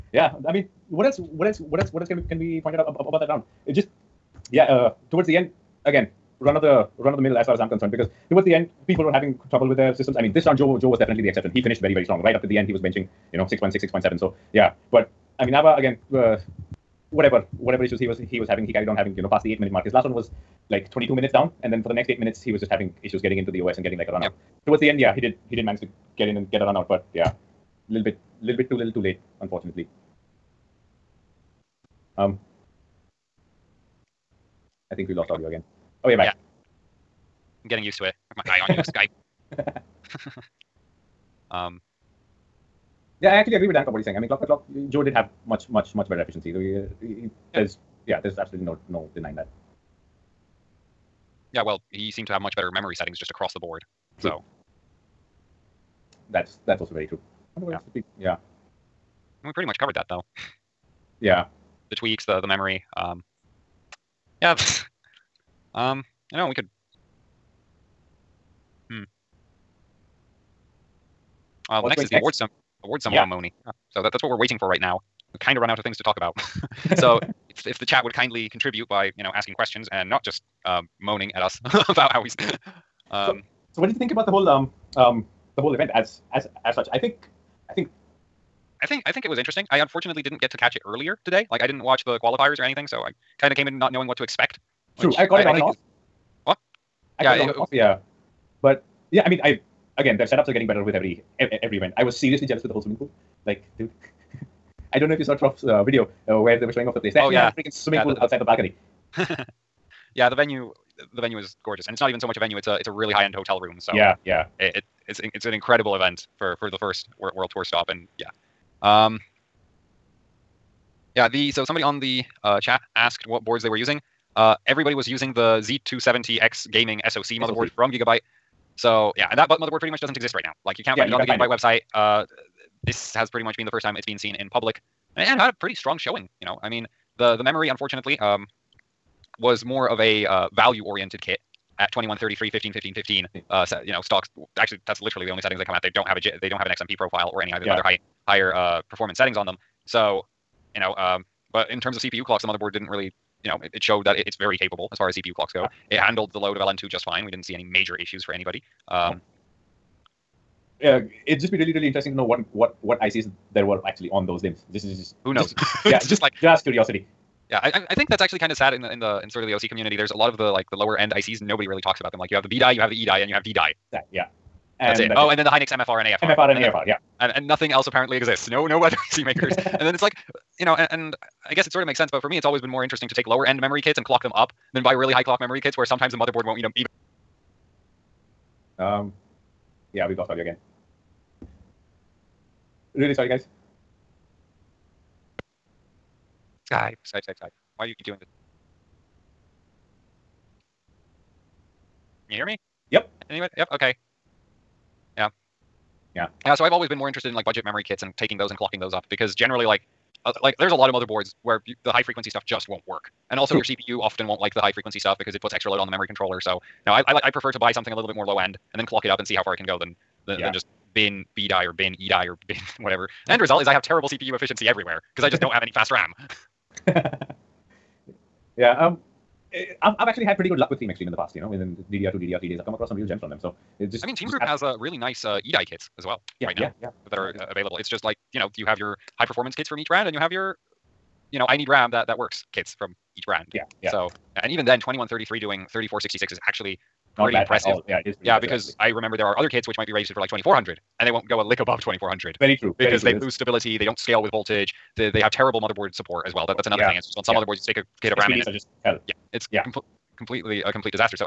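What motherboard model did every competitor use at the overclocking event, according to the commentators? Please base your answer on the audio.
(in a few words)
Z270X Gaming SoC.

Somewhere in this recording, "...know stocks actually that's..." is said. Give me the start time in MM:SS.
02:23.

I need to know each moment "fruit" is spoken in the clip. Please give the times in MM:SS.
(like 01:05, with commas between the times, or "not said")
not said.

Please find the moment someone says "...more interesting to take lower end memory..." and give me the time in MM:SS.
03:02.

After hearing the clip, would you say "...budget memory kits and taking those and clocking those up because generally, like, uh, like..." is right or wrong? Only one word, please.
right.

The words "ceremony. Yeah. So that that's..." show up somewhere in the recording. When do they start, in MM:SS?
01:13.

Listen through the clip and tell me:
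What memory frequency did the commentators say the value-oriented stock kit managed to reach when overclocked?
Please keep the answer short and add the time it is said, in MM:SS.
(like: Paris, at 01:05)
3466, at 04:05.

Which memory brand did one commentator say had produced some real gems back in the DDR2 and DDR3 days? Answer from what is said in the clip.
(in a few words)
Team Xtreem.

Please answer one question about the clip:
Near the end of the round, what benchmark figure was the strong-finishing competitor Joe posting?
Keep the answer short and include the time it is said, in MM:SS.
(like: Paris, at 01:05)
6.6, at 00:13.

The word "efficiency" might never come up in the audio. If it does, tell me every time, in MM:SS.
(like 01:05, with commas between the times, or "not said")
00:46, 03:44.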